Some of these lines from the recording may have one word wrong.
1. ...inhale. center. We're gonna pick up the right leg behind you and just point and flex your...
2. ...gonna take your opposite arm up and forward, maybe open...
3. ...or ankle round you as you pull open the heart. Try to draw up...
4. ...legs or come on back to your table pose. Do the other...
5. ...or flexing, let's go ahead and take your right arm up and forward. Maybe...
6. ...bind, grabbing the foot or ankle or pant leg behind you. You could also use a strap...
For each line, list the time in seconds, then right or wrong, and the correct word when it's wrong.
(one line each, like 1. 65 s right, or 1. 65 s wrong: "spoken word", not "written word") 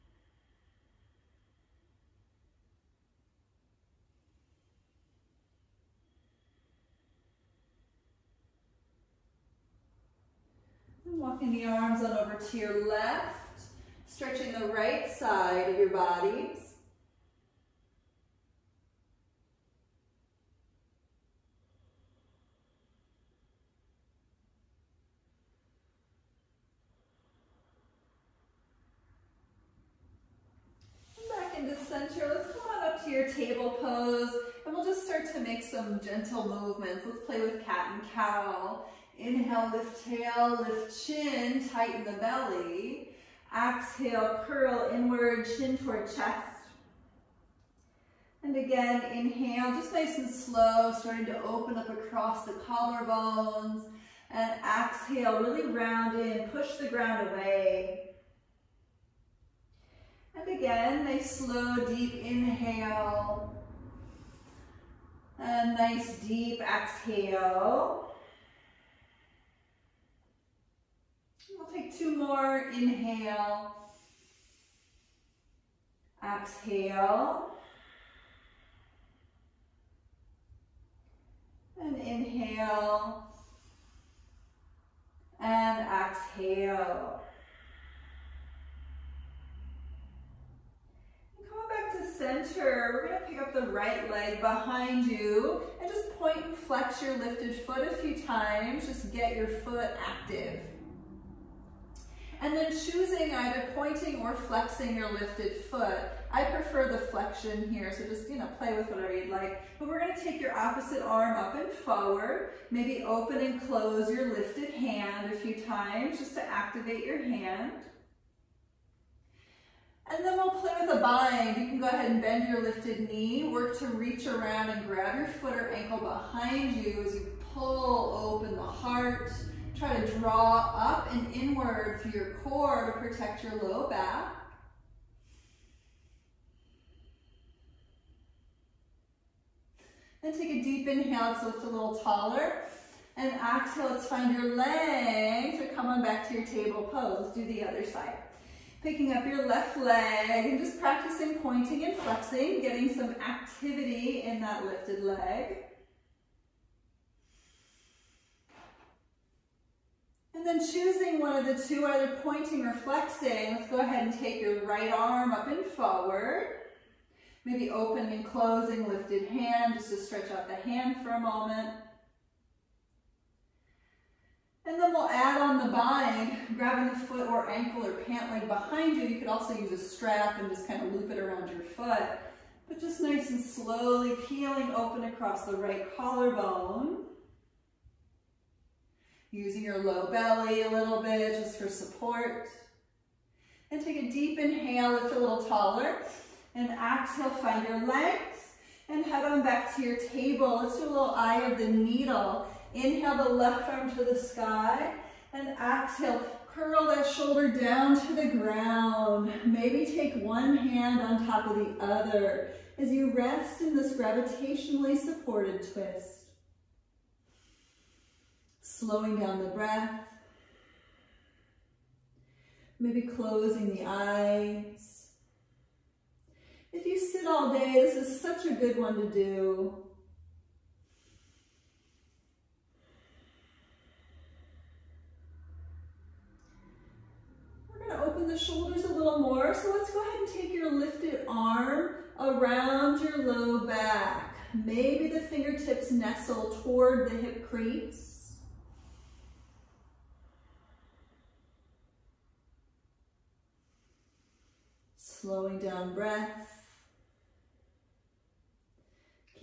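1. 85 s wrong: "exhale", not "inhale"
2. 109 s right
3. 125 s wrong: "behind", not "round"
4. 144 s right
5. 162 s right
6. 175 s right.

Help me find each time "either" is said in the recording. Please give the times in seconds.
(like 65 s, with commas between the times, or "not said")
103 s, 161 s.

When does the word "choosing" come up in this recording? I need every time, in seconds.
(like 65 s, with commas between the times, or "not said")
102 s, 160 s.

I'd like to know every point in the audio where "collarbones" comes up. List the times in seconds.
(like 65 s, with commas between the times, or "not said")
52 s, 185 s.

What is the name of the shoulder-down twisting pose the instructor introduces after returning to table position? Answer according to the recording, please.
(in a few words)
eye of the needle.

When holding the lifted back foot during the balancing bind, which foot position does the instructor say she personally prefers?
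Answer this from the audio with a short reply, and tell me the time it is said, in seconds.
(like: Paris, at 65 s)
flexion, at 106 s.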